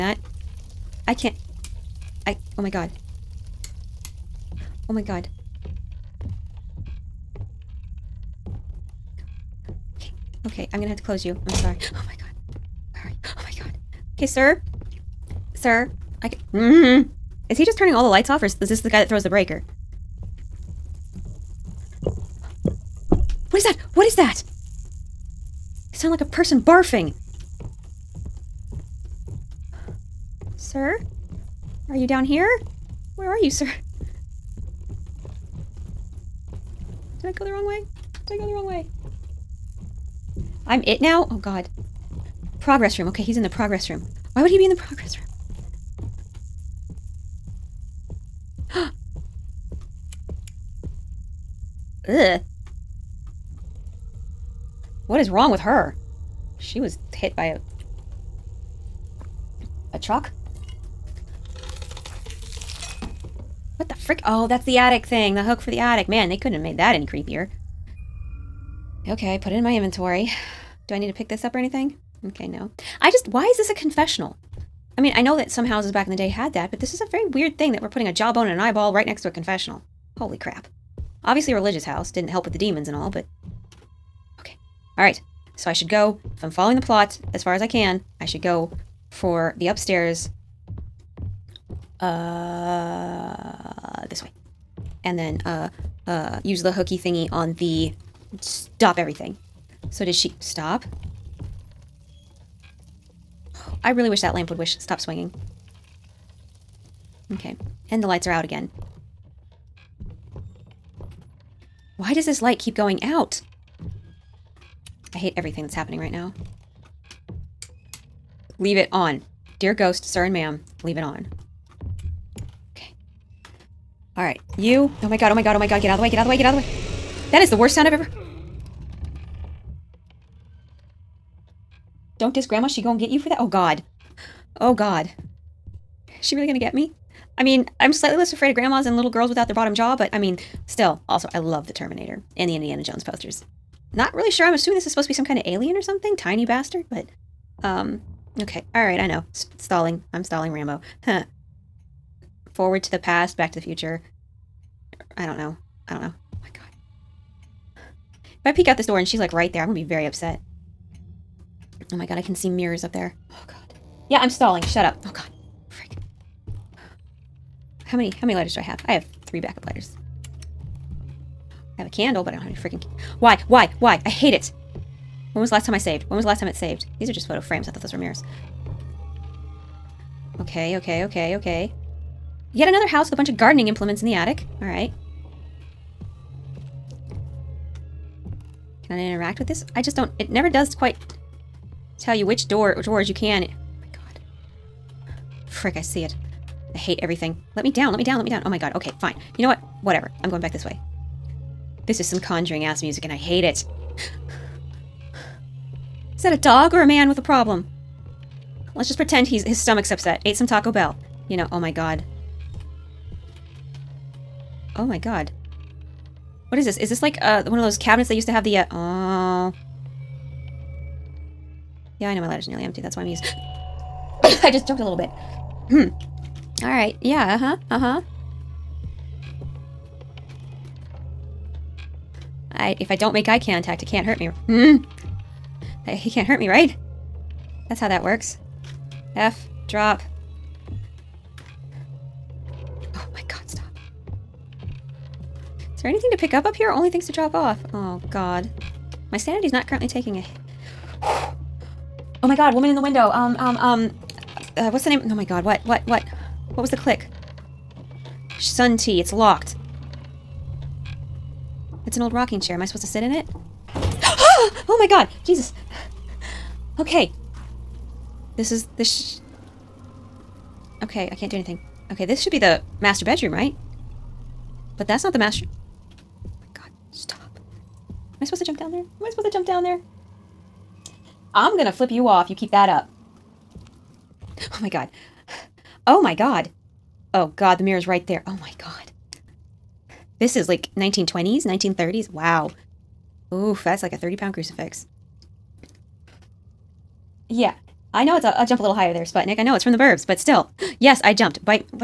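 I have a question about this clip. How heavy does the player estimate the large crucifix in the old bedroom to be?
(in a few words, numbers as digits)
30 pounds.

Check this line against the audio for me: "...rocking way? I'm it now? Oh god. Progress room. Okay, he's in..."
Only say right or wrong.
wrong.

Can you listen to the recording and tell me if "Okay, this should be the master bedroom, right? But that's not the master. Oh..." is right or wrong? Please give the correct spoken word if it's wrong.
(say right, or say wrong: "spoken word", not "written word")
right.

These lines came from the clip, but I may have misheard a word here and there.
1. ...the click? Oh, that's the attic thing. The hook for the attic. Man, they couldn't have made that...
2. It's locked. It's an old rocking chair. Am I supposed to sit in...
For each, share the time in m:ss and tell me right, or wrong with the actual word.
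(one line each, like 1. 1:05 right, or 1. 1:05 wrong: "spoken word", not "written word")
1. 1:03 wrong: "frick", not "click"
2. 4:18 right.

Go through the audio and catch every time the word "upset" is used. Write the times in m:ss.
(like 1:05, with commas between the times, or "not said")
2:40, 3:29.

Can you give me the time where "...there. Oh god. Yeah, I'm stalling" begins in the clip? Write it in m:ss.
2:42.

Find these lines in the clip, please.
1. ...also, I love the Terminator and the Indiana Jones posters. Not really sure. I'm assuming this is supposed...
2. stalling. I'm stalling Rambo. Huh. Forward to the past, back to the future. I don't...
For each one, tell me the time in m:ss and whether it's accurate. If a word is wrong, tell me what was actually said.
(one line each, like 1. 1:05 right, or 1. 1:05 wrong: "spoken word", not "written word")
1. 2:21 right
2. 2:29 right.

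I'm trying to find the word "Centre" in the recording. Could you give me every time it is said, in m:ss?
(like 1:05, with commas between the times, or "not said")
not said.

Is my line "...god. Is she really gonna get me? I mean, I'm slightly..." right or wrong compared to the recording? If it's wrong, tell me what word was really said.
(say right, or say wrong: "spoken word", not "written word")
right.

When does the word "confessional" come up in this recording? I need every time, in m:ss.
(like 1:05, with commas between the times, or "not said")
1:13, 1:19.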